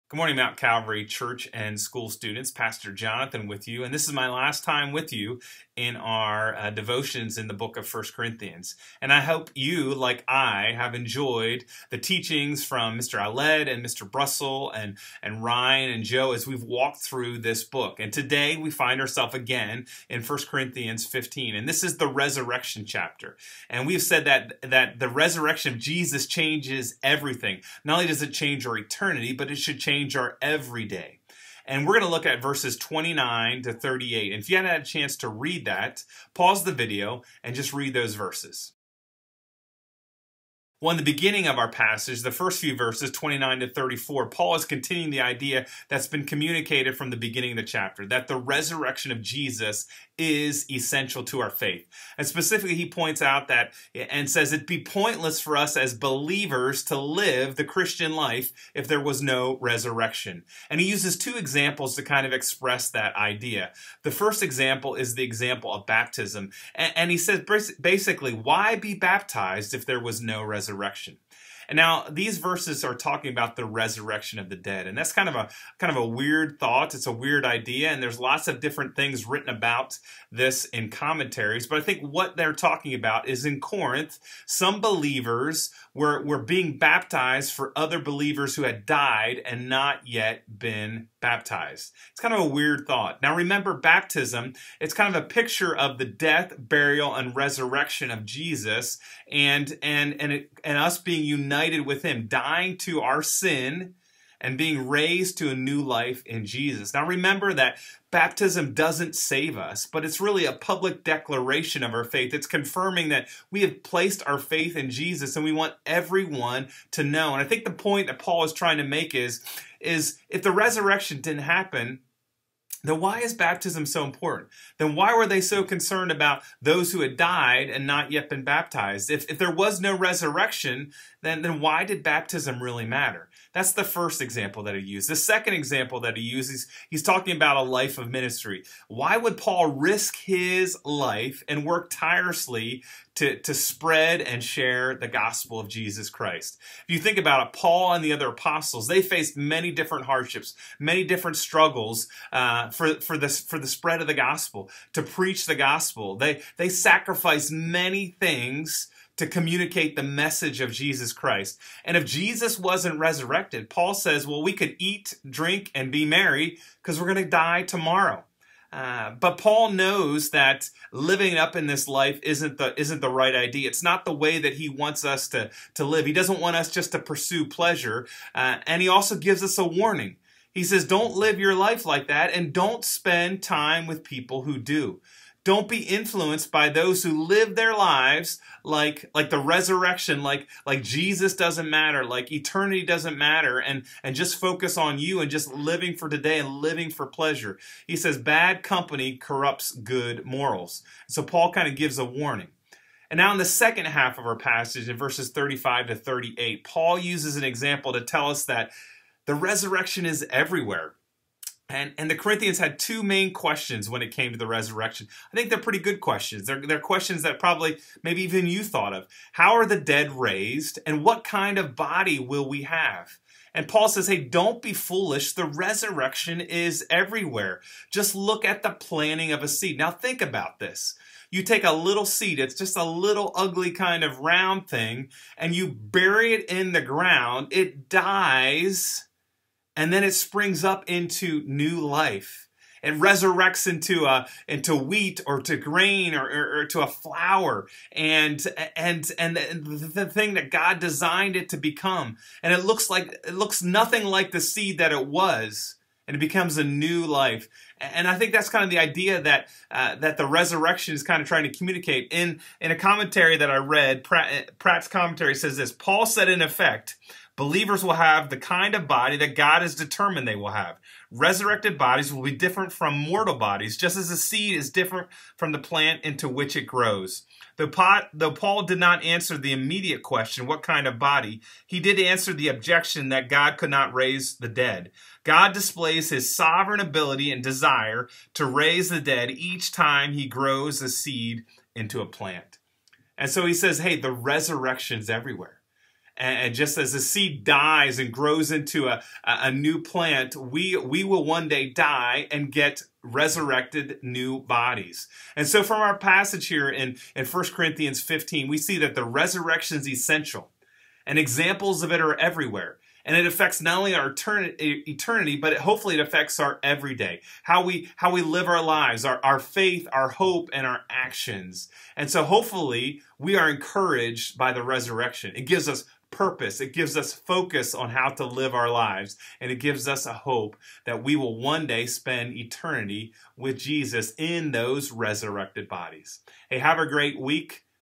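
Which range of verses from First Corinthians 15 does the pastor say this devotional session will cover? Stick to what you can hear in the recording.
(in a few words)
29 to 38.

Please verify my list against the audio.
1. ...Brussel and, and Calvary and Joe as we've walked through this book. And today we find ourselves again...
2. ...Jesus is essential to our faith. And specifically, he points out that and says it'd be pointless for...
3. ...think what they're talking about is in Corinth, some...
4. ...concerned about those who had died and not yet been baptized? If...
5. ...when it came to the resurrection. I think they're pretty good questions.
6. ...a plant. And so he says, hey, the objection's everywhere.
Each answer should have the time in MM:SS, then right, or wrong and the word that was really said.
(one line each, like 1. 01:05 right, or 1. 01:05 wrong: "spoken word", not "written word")
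1. 00:14 wrong: "Ryan", not "Calvary"
2. 00:49 right
3. 01:21 right
4. 02:05 right
5. 03:33 right
6. 04:52 wrong: "resurrection", not "objection".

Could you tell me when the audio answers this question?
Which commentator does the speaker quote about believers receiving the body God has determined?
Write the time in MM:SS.
04:24.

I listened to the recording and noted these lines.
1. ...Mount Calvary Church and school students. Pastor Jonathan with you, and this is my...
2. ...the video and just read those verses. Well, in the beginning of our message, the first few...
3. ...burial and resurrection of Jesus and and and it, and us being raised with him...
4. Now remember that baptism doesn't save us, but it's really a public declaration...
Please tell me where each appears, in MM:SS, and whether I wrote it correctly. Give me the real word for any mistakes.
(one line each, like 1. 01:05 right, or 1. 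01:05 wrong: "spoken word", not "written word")
1. 00:00 right
2. 00:36 wrong: "passage", not "message"
3. 01:36 wrong: "united", not "raised"
4. 01:46 right.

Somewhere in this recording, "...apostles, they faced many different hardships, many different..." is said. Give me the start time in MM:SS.
02:28.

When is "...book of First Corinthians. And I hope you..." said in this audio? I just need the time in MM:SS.
00:07.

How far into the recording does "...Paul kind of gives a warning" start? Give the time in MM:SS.
03:21.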